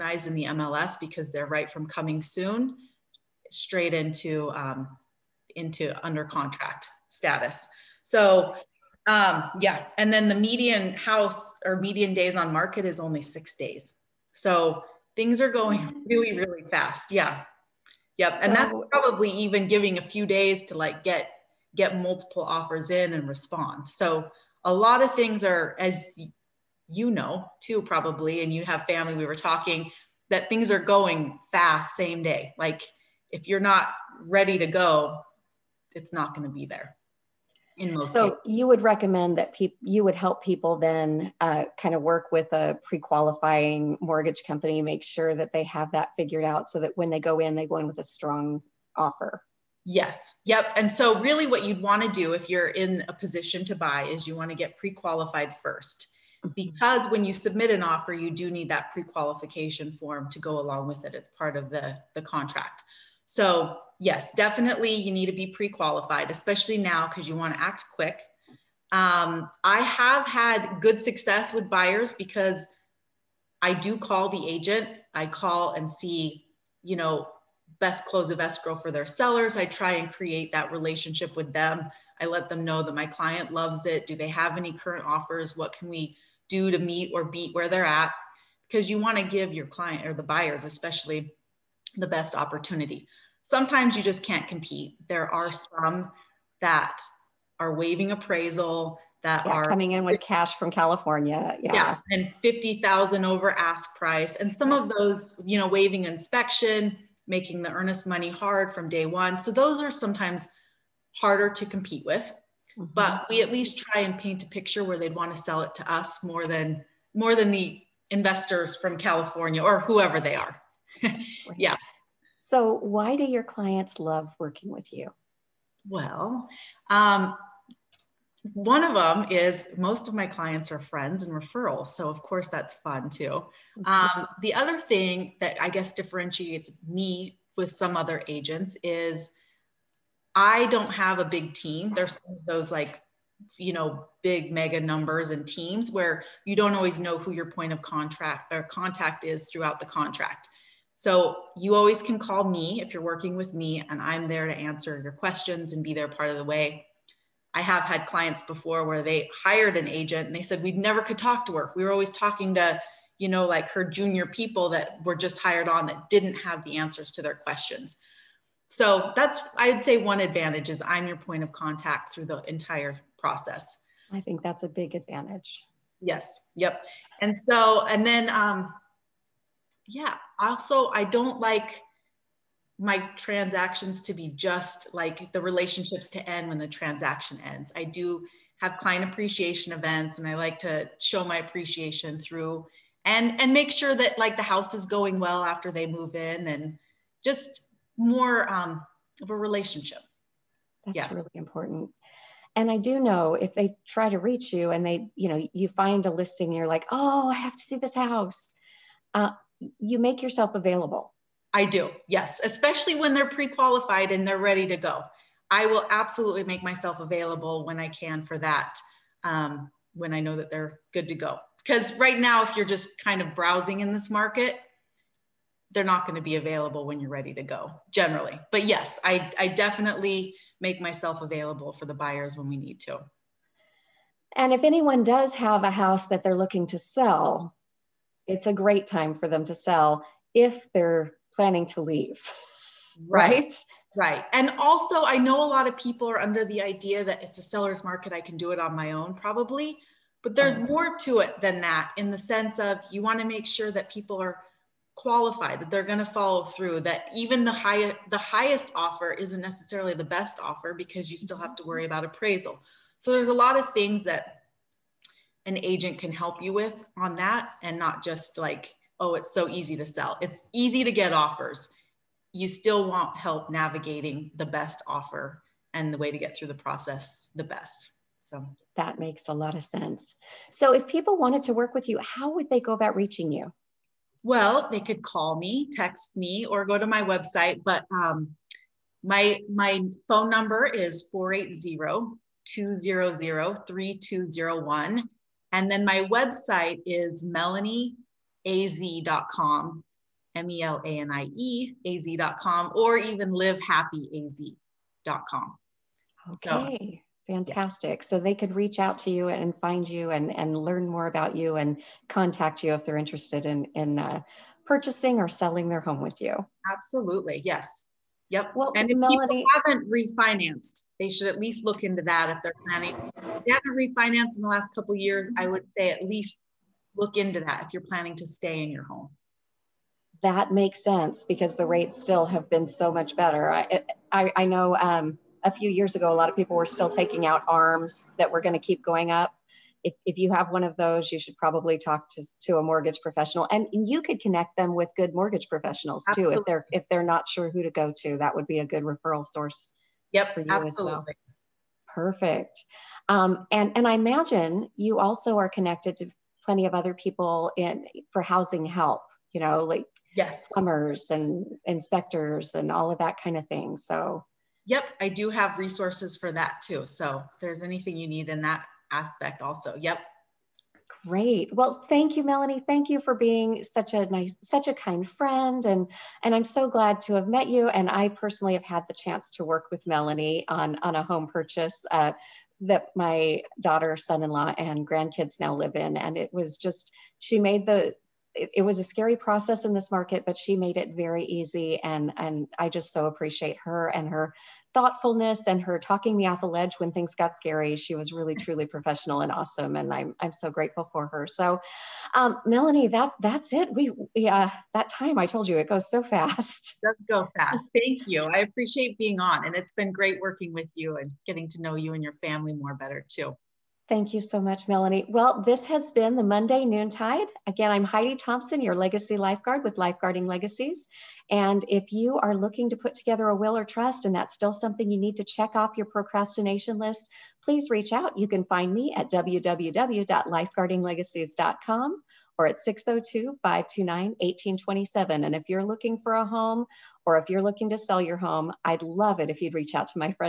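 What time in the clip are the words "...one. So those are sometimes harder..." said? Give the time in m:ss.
1:49.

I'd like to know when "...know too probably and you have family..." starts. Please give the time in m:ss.
0:27.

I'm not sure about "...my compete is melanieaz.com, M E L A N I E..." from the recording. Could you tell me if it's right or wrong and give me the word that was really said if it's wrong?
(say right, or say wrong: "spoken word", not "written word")
wrong: "website", not "compete".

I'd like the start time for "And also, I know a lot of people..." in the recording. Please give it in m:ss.
4:04.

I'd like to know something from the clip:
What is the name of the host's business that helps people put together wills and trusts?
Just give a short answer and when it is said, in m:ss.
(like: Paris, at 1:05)
Lifeguarding Legacies, at 6:59.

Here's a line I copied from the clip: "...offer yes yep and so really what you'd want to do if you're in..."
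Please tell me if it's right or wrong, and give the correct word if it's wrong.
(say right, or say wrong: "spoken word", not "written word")
right.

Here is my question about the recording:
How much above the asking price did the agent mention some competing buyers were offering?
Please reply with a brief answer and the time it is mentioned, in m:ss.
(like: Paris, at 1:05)
50,000, at 1:42.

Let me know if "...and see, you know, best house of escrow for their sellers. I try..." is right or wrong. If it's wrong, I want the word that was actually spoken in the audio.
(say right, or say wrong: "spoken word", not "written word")
wrong: "close", not "house".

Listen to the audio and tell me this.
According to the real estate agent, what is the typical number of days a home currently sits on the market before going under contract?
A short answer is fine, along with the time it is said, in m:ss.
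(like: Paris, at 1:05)
6 days, at 0:13.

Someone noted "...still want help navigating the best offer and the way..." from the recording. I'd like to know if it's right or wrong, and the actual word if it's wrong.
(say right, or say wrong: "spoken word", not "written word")
right.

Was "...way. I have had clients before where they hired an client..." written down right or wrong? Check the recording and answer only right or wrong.
wrong.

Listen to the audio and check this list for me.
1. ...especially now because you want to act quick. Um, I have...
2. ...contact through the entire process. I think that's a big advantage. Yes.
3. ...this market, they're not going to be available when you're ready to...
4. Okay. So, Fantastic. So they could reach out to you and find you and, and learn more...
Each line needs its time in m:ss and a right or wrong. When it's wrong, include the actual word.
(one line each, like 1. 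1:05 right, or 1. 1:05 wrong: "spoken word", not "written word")
1. 1:06 right
2. 2:51 right
3. 3:43 right
4. 5:06 right.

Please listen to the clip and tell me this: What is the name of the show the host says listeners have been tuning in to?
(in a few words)
Monday Noontide.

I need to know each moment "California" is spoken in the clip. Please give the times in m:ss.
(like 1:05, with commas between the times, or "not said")
1:40, 1:58.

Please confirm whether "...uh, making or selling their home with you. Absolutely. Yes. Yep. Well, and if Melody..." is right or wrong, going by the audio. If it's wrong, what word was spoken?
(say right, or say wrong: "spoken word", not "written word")
wrong: "purchasing", not "making".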